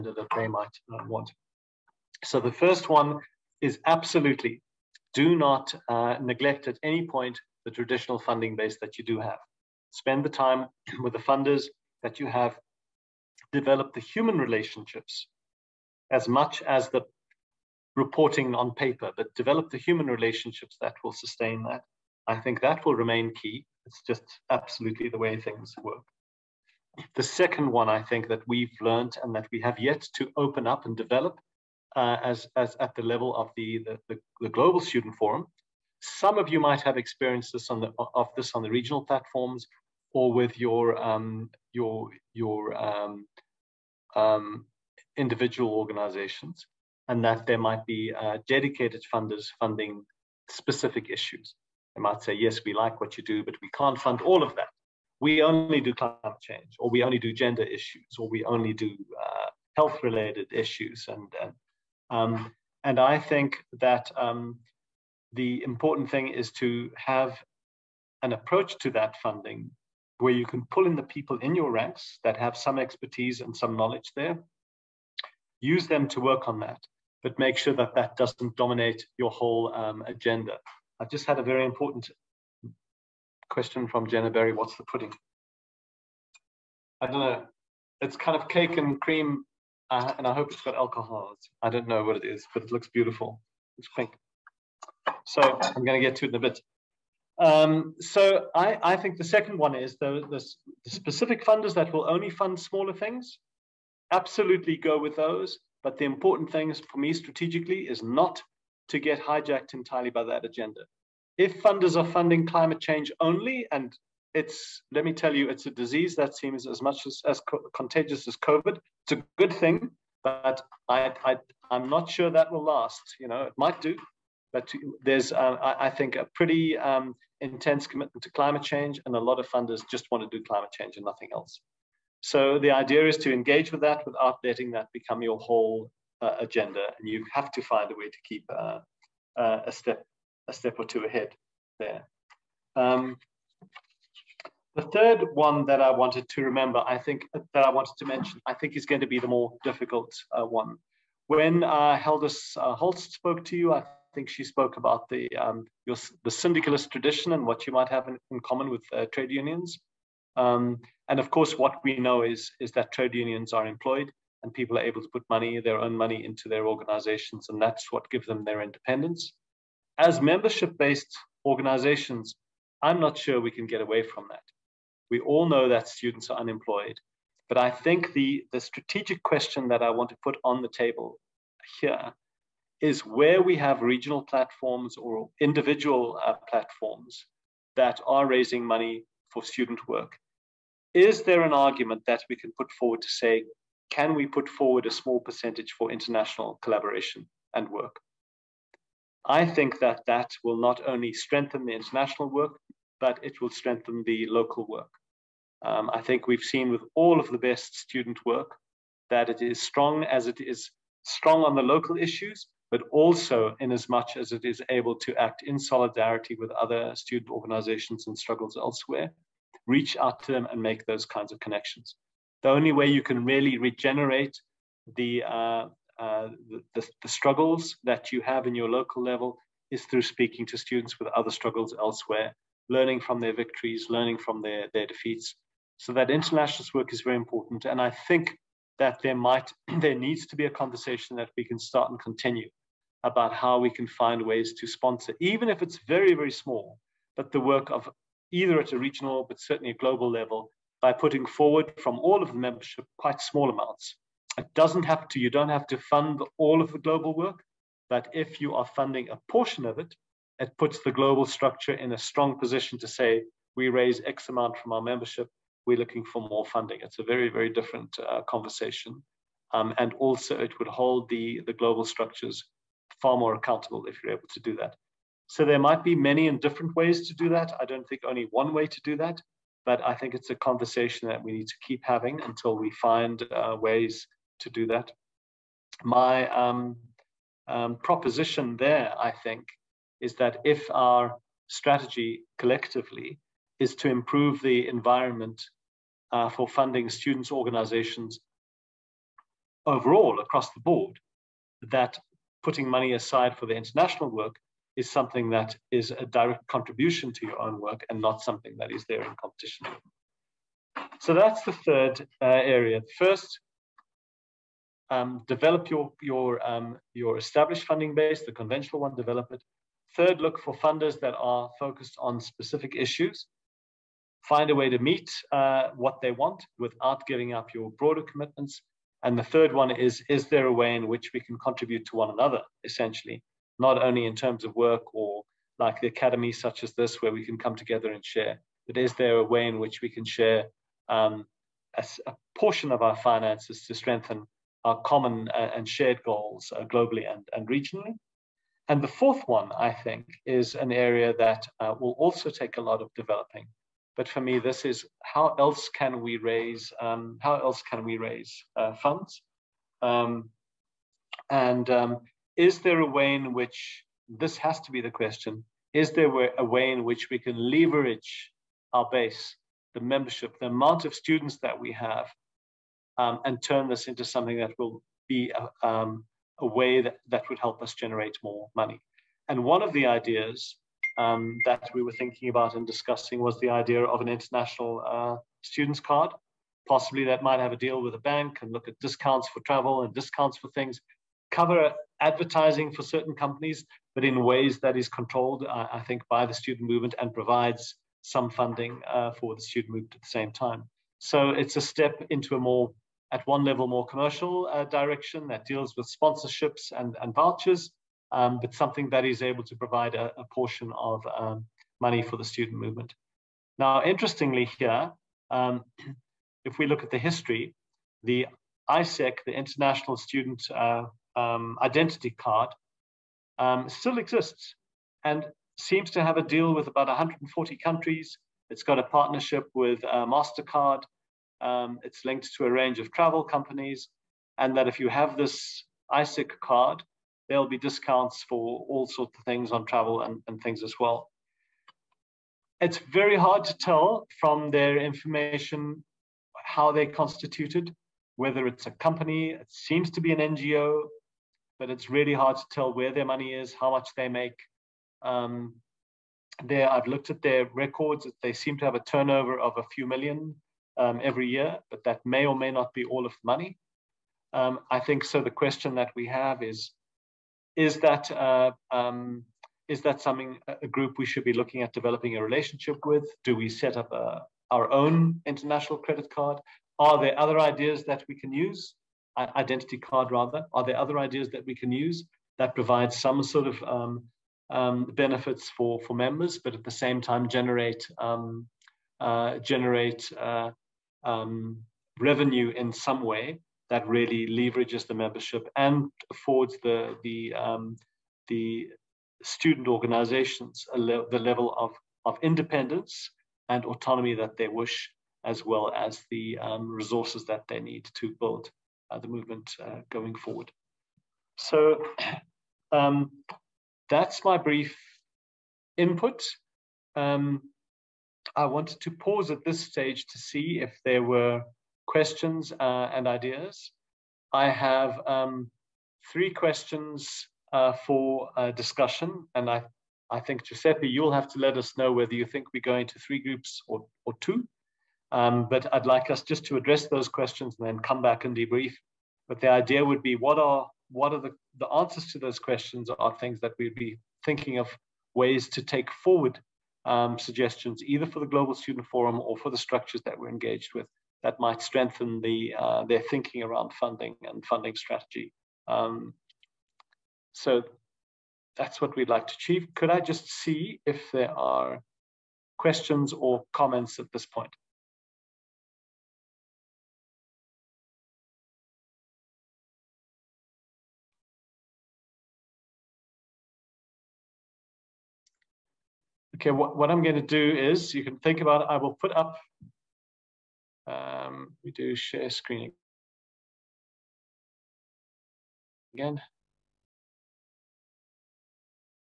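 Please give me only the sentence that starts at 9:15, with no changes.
Um, so that's what we'd like to achieve.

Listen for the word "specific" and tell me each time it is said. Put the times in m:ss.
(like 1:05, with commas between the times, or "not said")
0:50, 1:40, 5:22.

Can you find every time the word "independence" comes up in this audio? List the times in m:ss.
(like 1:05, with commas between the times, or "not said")
2:48, 8:22.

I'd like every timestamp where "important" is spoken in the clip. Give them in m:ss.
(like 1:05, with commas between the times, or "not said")
1:05, 1:21, 1:46, 3:57.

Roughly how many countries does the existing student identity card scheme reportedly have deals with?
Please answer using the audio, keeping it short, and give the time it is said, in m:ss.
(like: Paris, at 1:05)
140, at 7:06.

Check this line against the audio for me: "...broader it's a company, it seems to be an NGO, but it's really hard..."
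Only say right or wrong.
wrong.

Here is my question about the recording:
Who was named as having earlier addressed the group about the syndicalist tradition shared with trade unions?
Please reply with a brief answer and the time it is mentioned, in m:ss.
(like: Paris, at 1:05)
Haldis Holst, at 2:31.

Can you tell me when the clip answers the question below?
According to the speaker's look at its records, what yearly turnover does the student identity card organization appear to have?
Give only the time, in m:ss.
7:39.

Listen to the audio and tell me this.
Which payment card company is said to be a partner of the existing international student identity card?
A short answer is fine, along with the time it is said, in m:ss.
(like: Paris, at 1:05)
MasterCard, at 7:10.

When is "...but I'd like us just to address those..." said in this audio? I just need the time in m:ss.
8:55.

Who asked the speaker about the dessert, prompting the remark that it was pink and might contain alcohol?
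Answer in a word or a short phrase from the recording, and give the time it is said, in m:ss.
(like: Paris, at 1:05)
Jenna Berry, at 1:24.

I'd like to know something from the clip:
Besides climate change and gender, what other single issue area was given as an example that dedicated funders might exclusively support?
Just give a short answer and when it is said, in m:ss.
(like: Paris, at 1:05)
Health, at 0:59.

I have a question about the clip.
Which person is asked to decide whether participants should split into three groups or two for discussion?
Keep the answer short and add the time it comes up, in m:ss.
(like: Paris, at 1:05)
Giuseppe, at 8:50.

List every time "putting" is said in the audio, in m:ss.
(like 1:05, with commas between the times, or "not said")
4:10, 5:02.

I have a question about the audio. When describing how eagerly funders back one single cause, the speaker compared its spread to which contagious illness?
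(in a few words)
COVID.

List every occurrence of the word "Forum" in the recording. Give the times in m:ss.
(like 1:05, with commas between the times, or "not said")
0:35, 9:08.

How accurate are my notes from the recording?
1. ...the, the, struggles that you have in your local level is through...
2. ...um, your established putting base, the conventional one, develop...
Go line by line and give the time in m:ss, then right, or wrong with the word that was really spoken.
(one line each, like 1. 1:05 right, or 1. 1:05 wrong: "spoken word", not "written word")
1. 3:46 right
2. 5:16 wrong: "funding", not "putting".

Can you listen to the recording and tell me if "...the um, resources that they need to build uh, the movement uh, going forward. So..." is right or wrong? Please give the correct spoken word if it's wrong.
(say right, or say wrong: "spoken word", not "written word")
right.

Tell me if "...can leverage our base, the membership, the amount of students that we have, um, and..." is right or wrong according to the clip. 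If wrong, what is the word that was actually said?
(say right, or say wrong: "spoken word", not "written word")
right.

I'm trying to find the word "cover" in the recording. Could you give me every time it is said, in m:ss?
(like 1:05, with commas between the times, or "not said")
6:31.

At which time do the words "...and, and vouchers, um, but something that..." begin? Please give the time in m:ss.
6:46.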